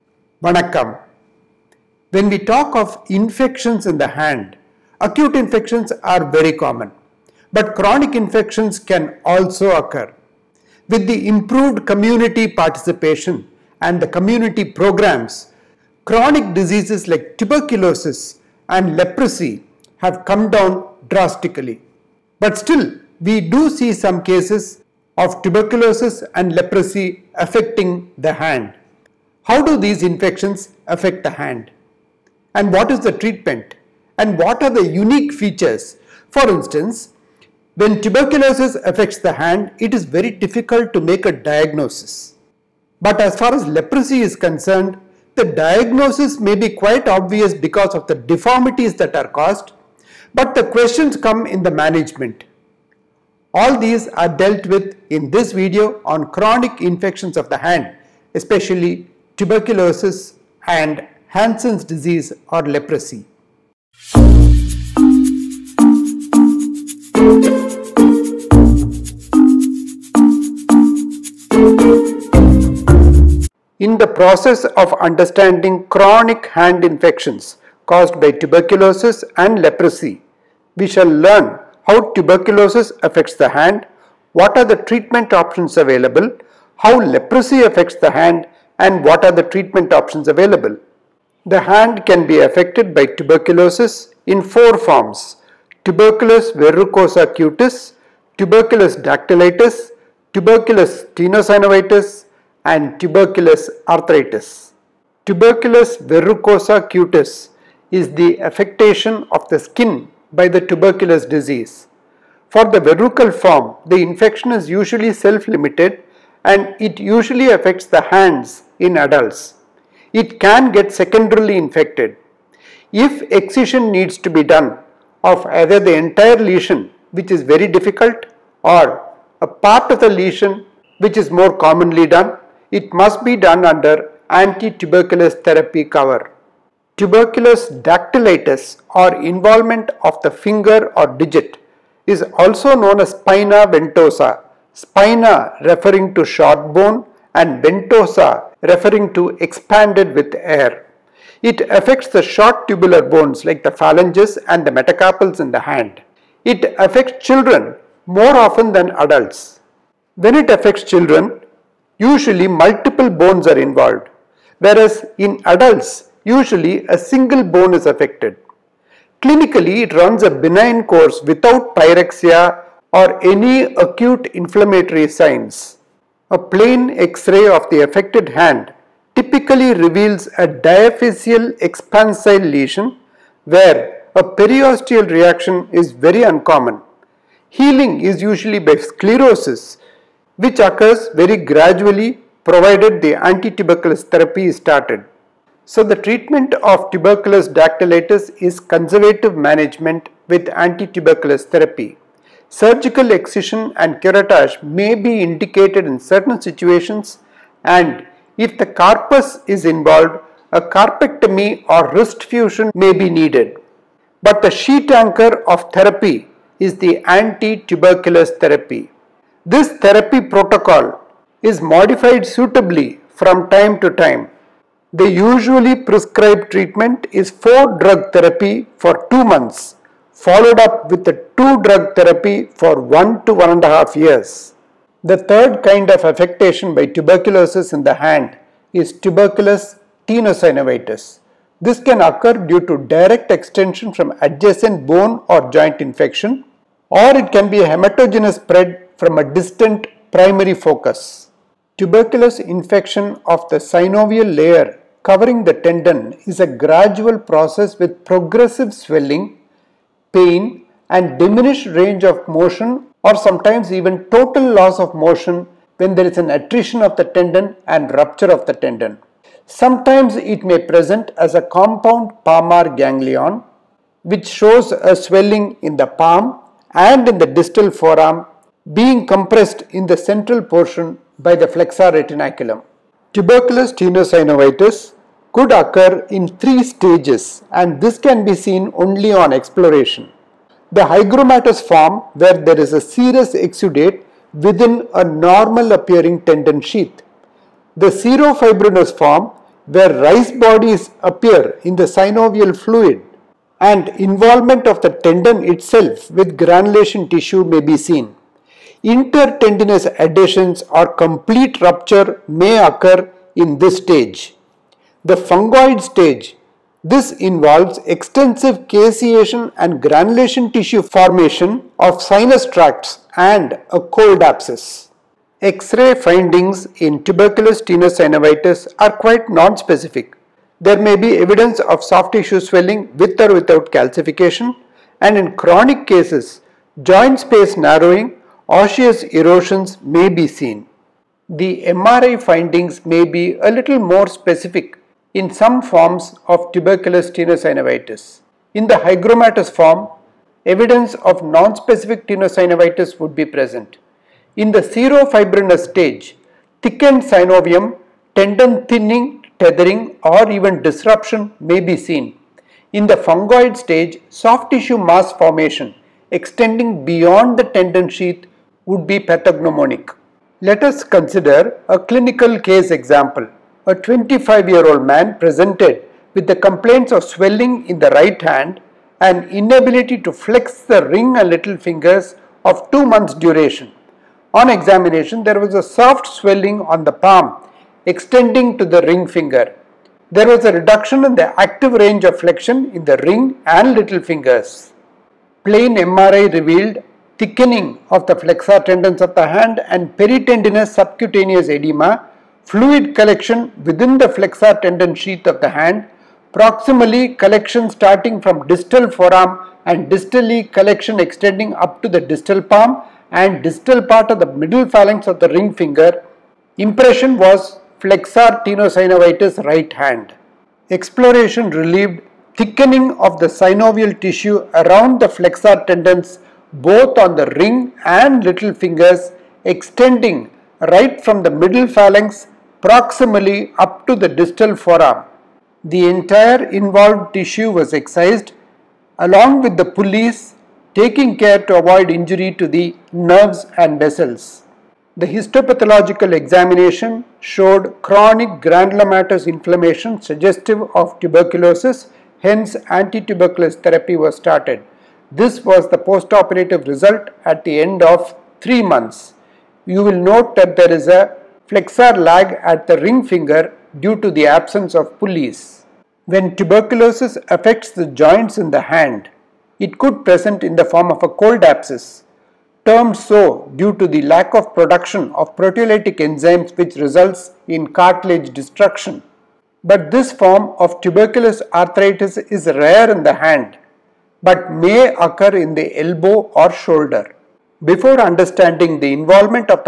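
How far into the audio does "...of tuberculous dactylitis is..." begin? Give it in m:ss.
3:16.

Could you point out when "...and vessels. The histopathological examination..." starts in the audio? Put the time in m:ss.
7:23.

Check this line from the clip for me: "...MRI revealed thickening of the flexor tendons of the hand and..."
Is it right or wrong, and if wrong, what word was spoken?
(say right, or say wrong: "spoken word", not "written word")
right.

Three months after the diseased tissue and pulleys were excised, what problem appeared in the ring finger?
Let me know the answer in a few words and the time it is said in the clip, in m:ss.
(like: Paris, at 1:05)
Flexor lag, at 7:41.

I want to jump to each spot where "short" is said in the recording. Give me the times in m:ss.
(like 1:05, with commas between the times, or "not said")
2:26, 2:32.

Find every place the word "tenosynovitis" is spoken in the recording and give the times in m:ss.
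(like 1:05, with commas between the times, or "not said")
1:41, 4:00, 4:43, 5:27, 5:47, 5:52, 6:58.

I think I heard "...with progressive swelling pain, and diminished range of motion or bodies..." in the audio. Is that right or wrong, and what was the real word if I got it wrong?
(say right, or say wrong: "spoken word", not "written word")
wrong: "sometimes", not "bodies".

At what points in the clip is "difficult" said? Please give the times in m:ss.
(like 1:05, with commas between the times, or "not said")
0:40, 2:07.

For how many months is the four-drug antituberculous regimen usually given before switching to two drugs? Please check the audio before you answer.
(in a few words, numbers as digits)
2.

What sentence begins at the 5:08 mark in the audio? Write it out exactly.
Intertendinous adhesions or complete rupture may occur in this stage the fungoid stage.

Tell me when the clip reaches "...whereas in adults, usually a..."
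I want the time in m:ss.
2:44.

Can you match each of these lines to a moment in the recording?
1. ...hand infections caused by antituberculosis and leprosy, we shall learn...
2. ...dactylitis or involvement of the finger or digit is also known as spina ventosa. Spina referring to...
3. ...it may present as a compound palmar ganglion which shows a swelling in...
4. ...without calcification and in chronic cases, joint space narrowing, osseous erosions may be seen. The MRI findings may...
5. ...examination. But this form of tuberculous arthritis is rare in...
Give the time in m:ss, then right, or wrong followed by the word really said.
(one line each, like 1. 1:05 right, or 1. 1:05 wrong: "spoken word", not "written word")
1. 1:16 wrong: "tuberculosis", not "antituberculosis"
2. 2:17 right
3. 4:30 right
4. 5:33 right
5. 7:58 wrong: "destruction", not "examination".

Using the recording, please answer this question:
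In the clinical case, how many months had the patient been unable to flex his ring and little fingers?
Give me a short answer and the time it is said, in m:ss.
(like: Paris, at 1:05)
2, at 6:22.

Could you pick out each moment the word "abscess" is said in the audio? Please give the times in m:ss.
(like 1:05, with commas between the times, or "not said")
5:24, 7:51.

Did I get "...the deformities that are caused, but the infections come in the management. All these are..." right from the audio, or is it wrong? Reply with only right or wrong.
wrong.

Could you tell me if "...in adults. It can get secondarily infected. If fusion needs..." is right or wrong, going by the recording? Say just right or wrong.
wrong.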